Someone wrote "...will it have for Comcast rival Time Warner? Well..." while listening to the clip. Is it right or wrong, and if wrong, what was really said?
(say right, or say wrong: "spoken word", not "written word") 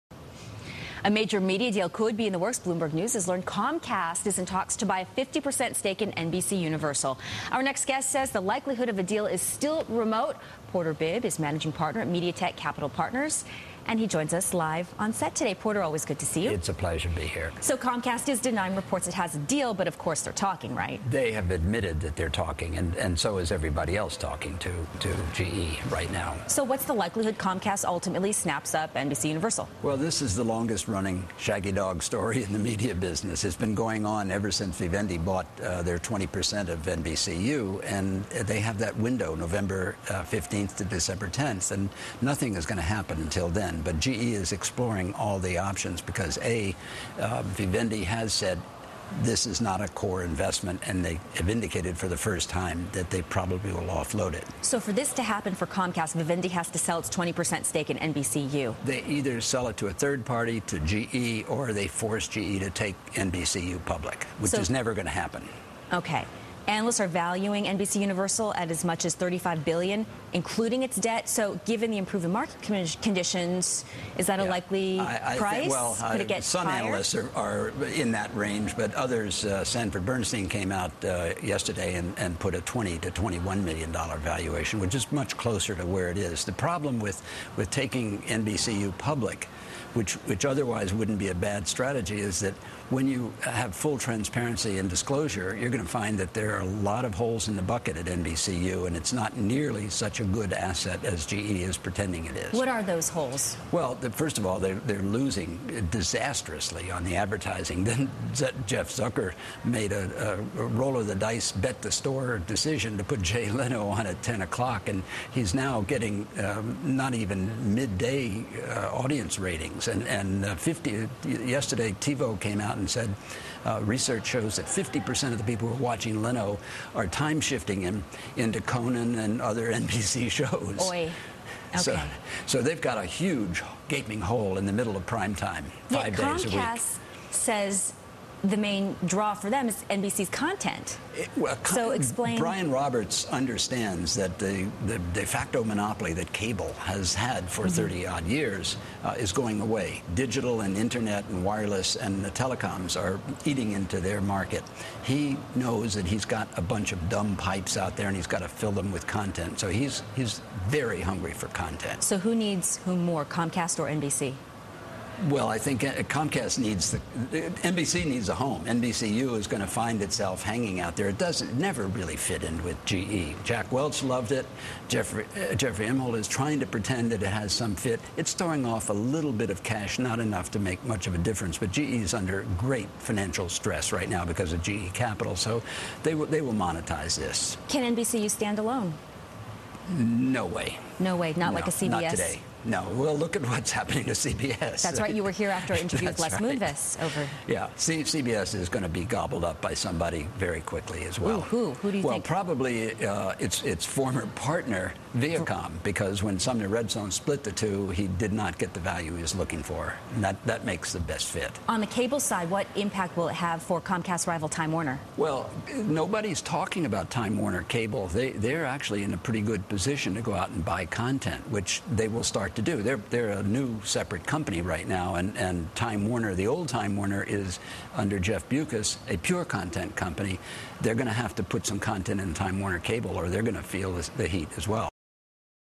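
right.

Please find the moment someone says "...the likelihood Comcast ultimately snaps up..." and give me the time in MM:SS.
00:26.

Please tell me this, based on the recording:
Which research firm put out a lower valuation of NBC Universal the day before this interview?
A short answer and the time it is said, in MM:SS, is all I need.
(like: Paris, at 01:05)
Sanford Bernstein, at 01:19.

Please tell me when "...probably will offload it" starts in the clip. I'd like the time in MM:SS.
00:53.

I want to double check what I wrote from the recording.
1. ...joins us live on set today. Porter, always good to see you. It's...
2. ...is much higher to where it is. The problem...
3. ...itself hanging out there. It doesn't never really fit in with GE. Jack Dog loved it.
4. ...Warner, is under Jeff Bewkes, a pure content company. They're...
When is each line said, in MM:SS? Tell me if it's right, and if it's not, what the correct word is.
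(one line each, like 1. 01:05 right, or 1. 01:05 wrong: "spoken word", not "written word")
1. 00:14 right
2. 01:24 wrong: "closer", not "higher"
3. 02:50 wrong: "Welch", not "Dog"
4. 03:46 right.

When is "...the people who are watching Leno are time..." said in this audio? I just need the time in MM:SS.
02:05.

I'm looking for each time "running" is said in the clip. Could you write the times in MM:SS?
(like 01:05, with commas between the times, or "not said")
00:30.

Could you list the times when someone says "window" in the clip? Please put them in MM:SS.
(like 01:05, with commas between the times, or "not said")
00:38.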